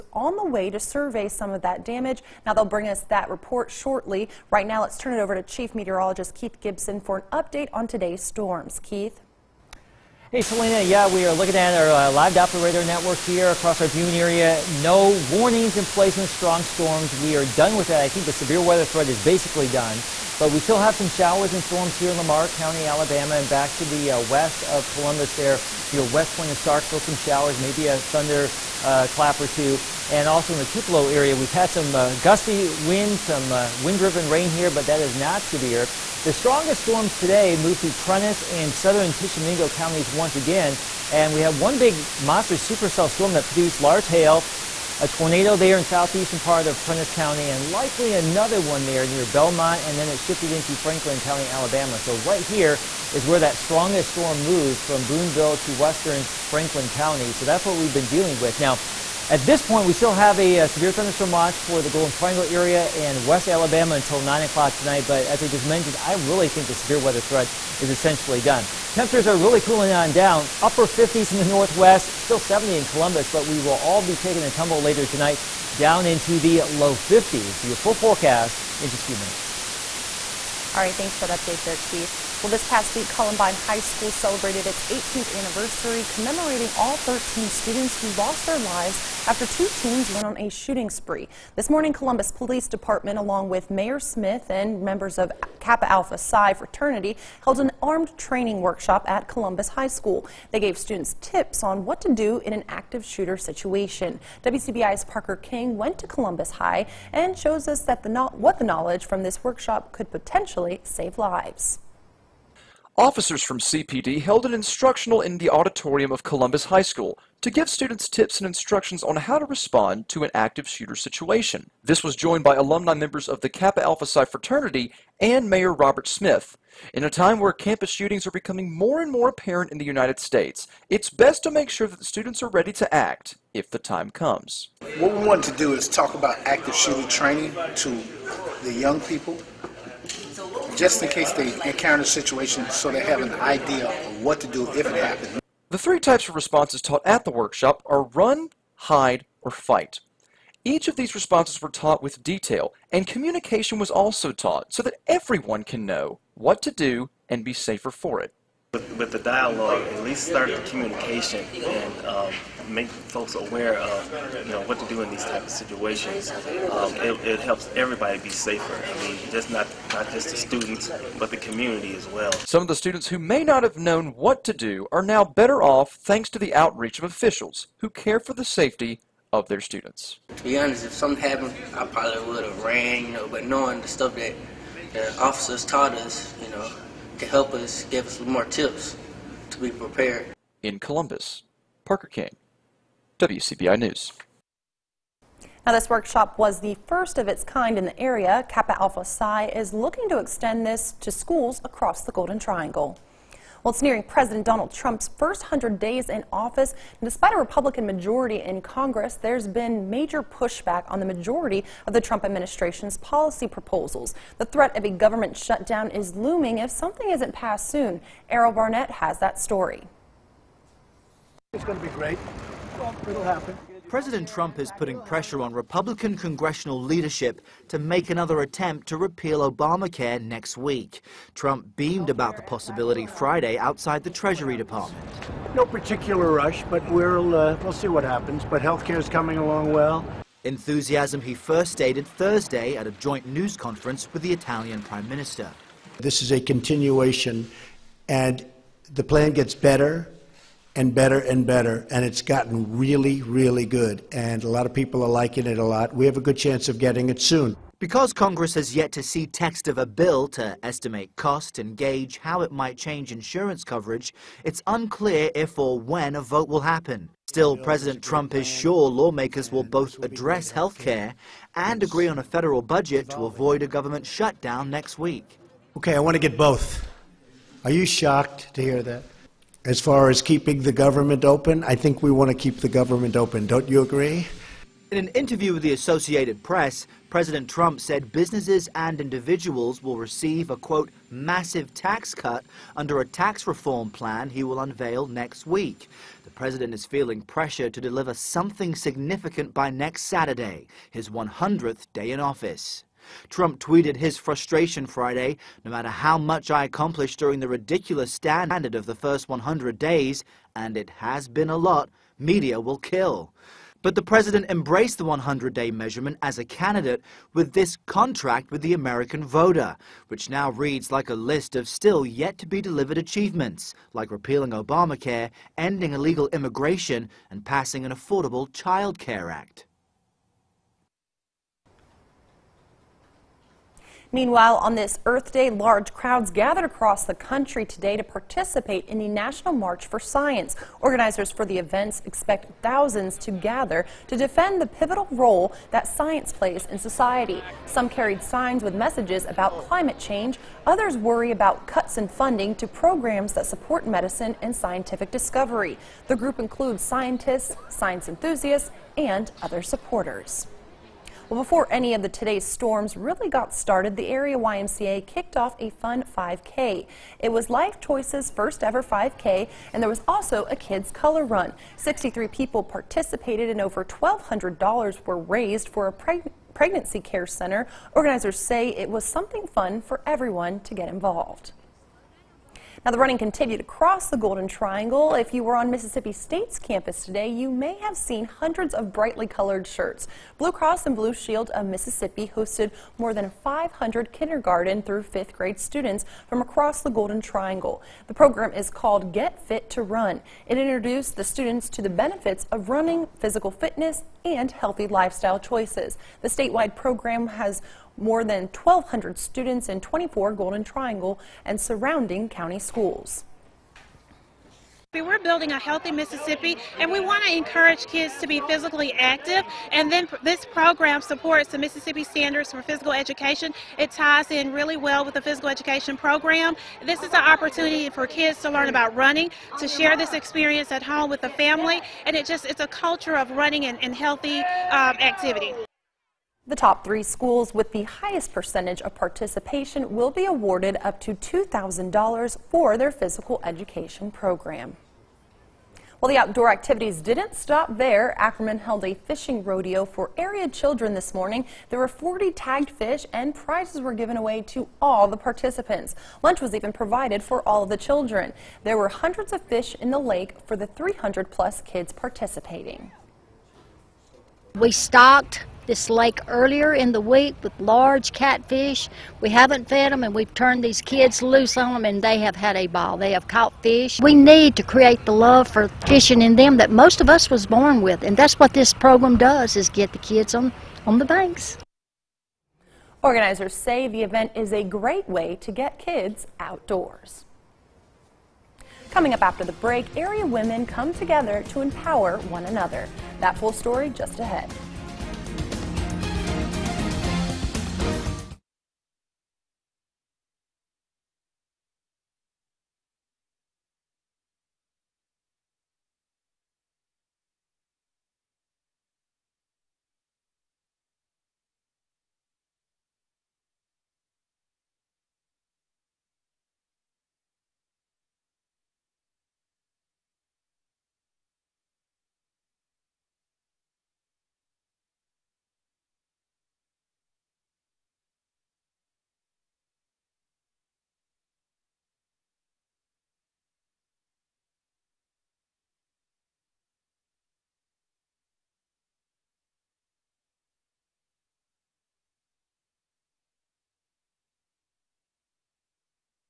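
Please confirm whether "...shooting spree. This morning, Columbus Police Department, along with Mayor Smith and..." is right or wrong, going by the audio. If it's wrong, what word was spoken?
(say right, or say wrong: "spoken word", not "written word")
right.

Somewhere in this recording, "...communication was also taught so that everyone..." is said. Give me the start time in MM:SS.
02:33.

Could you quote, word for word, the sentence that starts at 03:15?
Now, this workshop was the first of its kind in the area.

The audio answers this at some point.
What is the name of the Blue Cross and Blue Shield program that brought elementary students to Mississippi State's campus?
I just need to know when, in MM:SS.
06:39.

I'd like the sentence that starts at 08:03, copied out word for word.
Organizers say the event is a great way to get kids outdoors.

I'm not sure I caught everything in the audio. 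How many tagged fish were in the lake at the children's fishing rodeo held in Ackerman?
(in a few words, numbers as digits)
40.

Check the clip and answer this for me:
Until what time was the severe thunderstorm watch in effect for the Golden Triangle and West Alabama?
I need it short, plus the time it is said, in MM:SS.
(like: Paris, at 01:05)
9 o'clock, at 01:04.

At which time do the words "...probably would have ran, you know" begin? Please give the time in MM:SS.
03:01.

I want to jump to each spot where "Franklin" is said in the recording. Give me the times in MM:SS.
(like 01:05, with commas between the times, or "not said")
00:50, 00:56.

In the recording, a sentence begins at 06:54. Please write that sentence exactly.
We're building a healthy Mississippi, and we want to encourage kids to be physically active.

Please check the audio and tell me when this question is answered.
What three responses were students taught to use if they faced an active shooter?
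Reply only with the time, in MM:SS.
02:28.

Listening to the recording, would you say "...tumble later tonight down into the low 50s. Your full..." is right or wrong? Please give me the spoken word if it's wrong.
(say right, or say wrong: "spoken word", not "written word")
right.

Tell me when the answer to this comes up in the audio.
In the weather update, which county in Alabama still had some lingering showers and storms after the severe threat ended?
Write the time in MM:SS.
00:22.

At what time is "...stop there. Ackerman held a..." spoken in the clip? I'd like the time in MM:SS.
07:27.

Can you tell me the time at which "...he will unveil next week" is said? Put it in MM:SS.
04:54.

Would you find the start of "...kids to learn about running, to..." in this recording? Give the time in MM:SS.
07:08.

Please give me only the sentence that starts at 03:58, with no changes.
But health care is coming along well.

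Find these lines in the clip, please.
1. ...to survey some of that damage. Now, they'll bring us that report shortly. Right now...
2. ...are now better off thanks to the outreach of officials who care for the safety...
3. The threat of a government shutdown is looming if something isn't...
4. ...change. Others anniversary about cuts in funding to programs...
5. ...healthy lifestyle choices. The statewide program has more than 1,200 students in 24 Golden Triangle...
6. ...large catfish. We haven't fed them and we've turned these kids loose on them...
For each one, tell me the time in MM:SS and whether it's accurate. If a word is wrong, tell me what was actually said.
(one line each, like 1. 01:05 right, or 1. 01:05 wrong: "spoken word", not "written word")
1. 00:00 right
2. 02:54 right
3. 03:34 right
4. 05:49 wrong: "worry", not "anniversary"
5. 06:44 right
6. 07:47 right.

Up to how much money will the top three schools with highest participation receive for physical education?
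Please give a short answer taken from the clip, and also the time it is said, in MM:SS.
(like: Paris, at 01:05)
$2,000, at 07:21.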